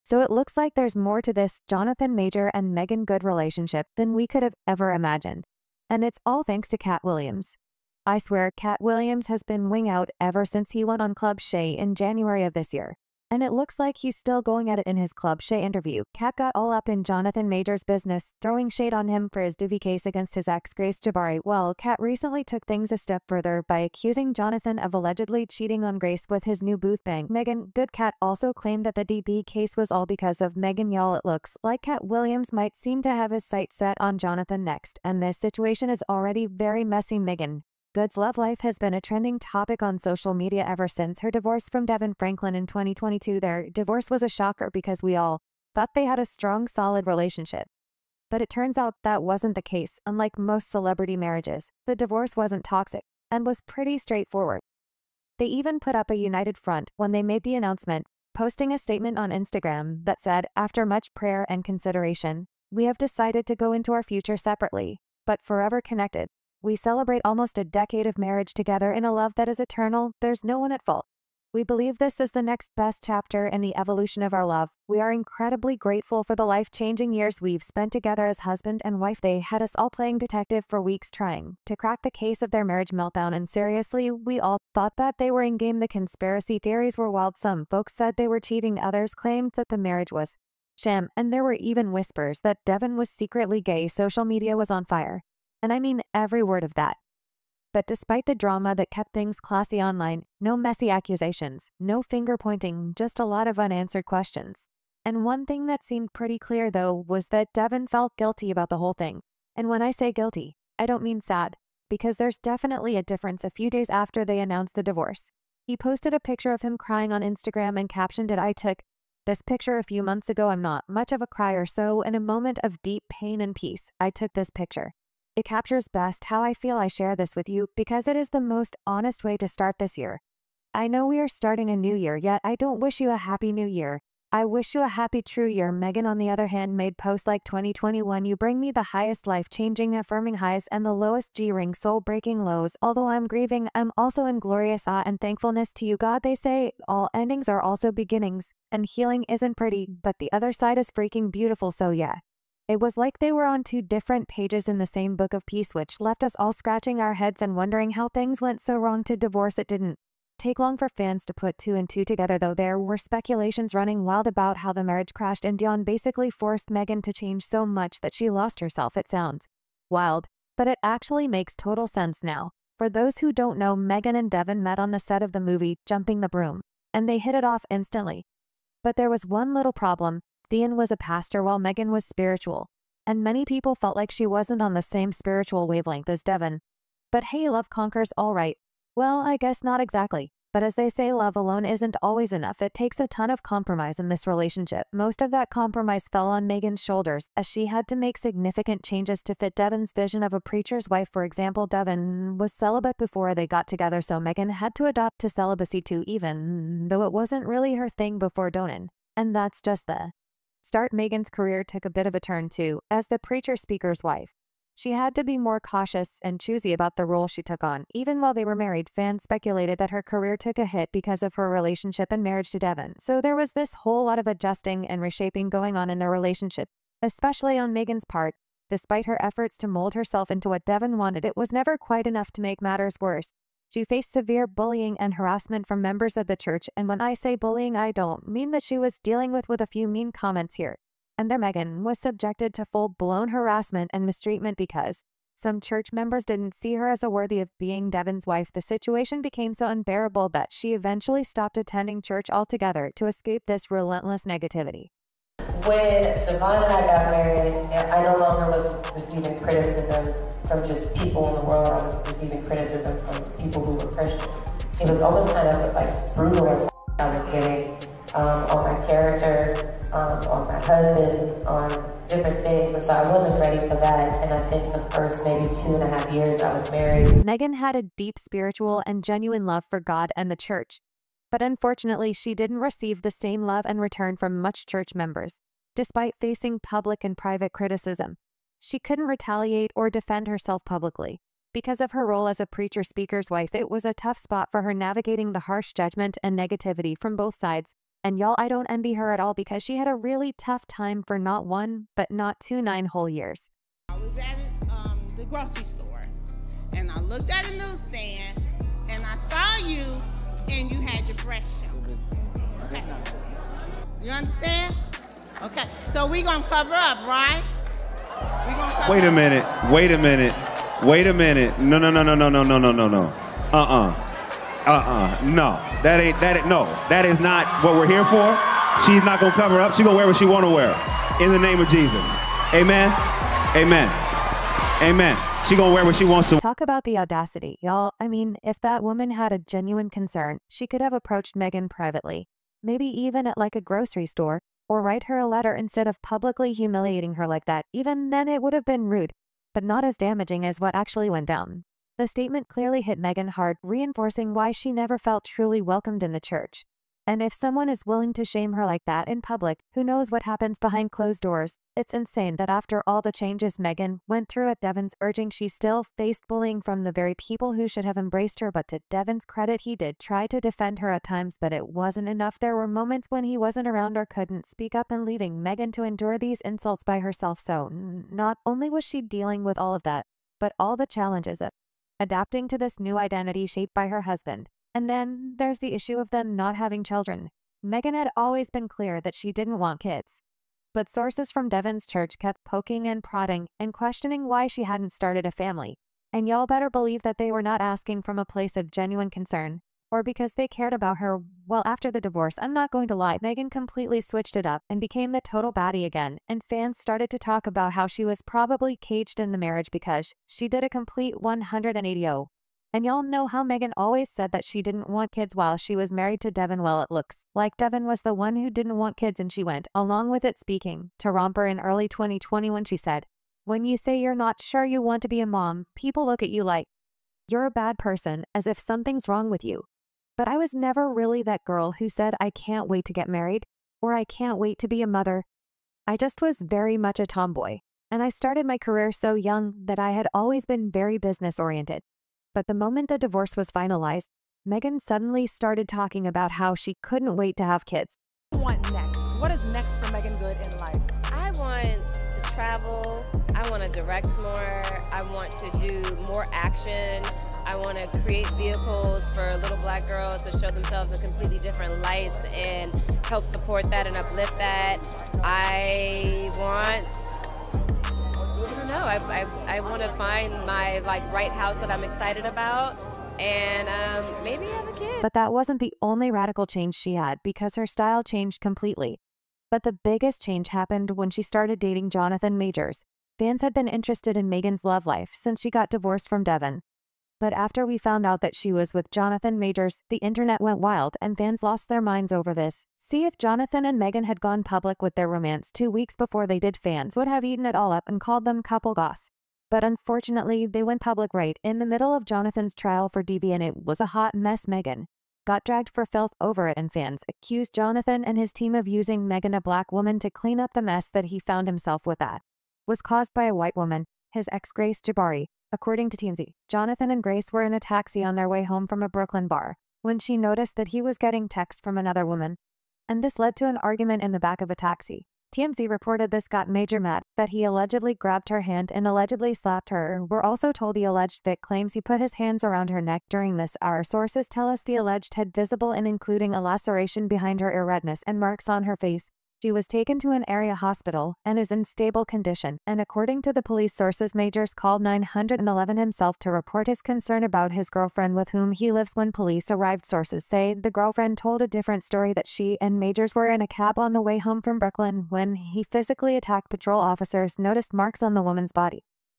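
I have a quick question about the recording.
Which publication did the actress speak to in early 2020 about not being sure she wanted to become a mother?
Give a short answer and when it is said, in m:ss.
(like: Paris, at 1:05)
Romper, at 7:01.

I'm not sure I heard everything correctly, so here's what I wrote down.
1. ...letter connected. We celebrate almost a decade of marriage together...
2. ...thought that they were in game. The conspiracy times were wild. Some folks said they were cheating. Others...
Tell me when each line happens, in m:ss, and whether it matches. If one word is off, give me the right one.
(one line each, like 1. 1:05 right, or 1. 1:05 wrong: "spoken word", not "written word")
1. 1:05 wrong: "forever", not "letter"
2. 1:24 wrong: "theories", not "times".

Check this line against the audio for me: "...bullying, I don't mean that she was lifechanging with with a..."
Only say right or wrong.
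wrong.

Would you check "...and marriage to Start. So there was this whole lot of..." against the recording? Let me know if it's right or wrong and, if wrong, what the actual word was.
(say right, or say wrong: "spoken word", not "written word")
wrong: "DeVon", not "Start".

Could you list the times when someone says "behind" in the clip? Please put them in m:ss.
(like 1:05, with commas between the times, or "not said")
6:00, 8:57.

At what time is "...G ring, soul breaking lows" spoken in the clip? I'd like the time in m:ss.
2:21.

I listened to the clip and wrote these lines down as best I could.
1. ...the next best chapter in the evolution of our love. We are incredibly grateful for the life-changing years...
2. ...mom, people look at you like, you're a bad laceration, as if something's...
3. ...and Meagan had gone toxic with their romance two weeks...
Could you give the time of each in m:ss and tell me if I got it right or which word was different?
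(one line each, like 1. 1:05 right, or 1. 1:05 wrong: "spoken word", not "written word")
1. 1:12 right
2. 7:05 wrong: "person", not "laceration"
3. 8:13 wrong: "public", not "toxic".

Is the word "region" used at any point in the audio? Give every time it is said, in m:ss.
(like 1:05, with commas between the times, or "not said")
not said.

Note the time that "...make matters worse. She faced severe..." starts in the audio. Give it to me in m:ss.
3:52.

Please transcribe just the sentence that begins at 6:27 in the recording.
Meagan had always been clear that she didn't want kids.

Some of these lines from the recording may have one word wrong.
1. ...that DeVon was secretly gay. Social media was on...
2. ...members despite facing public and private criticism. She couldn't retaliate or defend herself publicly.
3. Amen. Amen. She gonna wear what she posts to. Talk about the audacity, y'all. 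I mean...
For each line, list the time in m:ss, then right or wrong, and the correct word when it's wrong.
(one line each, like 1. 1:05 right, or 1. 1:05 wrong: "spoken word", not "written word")
1. 1:32 right
2. 4:44 right
3. 5:33 wrong: "wants", not "posts".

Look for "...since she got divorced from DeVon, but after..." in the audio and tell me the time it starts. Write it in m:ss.
8:05.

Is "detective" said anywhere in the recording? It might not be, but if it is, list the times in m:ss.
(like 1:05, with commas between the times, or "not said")
1:20.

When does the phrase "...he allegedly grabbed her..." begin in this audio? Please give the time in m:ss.
8:47.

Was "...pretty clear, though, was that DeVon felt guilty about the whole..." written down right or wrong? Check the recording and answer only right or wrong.
right.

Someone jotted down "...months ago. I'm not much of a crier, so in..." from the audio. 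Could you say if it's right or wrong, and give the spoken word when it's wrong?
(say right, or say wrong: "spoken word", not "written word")
right.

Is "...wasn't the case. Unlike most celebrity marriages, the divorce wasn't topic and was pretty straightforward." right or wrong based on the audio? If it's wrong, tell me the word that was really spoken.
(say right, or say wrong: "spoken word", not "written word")
wrong: "toxic", not "topic".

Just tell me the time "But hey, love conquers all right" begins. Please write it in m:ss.
3:07.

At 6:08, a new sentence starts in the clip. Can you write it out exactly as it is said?
But to DeVon's credit, he did try to defend her at times, but it wasn't enough.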